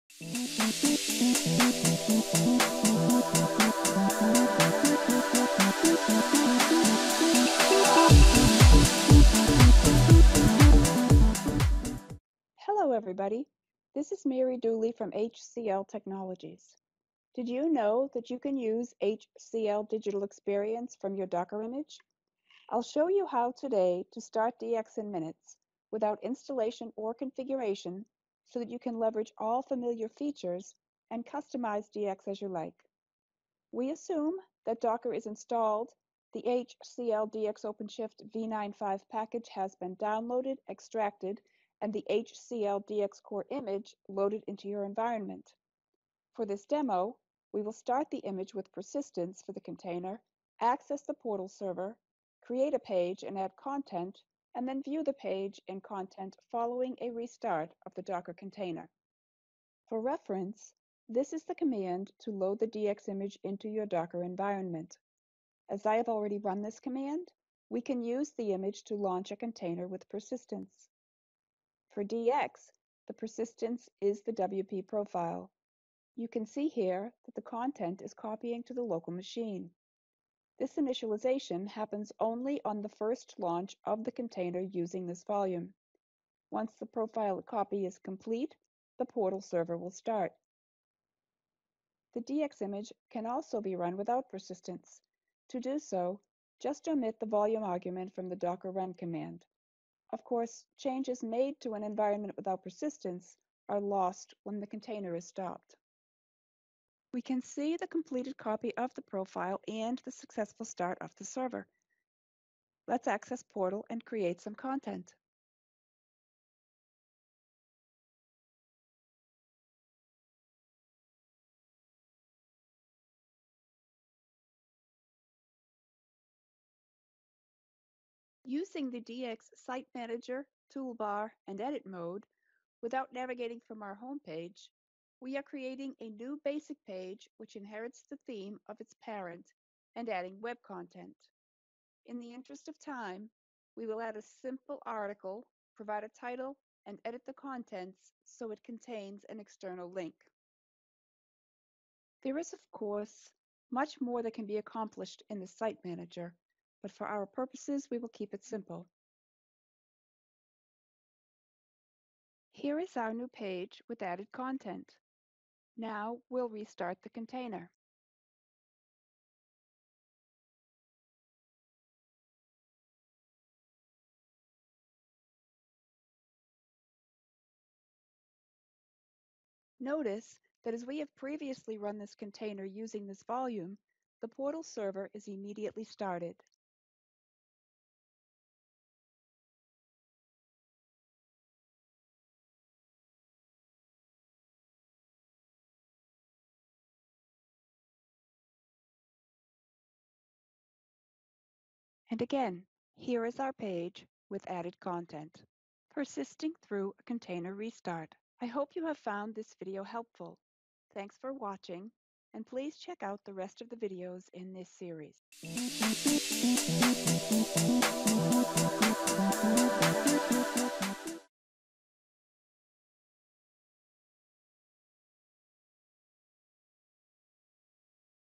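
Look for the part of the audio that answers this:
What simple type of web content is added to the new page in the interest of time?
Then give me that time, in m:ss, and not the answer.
2:24.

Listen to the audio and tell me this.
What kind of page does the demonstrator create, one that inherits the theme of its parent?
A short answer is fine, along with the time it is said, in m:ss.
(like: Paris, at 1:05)
basic page, at 2:16.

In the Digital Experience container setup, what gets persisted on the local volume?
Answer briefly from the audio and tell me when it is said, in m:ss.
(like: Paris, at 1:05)
WP profile, at 1:14.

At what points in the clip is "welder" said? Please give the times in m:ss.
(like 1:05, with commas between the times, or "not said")
not said.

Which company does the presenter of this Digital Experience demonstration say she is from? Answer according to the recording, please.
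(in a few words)
HCL Technologies.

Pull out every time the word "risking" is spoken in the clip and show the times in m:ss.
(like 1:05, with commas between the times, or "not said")
not said.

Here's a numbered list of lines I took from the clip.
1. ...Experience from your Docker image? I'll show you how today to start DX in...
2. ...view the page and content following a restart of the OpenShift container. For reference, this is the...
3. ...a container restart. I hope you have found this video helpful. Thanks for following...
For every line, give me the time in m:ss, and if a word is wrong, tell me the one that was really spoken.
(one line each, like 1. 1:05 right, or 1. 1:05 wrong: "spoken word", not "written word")
1. 0:20 right
2. 0:54 wrong: "Docker", not "OpenShift"
3. 3:26 wrong: "watching", not "following".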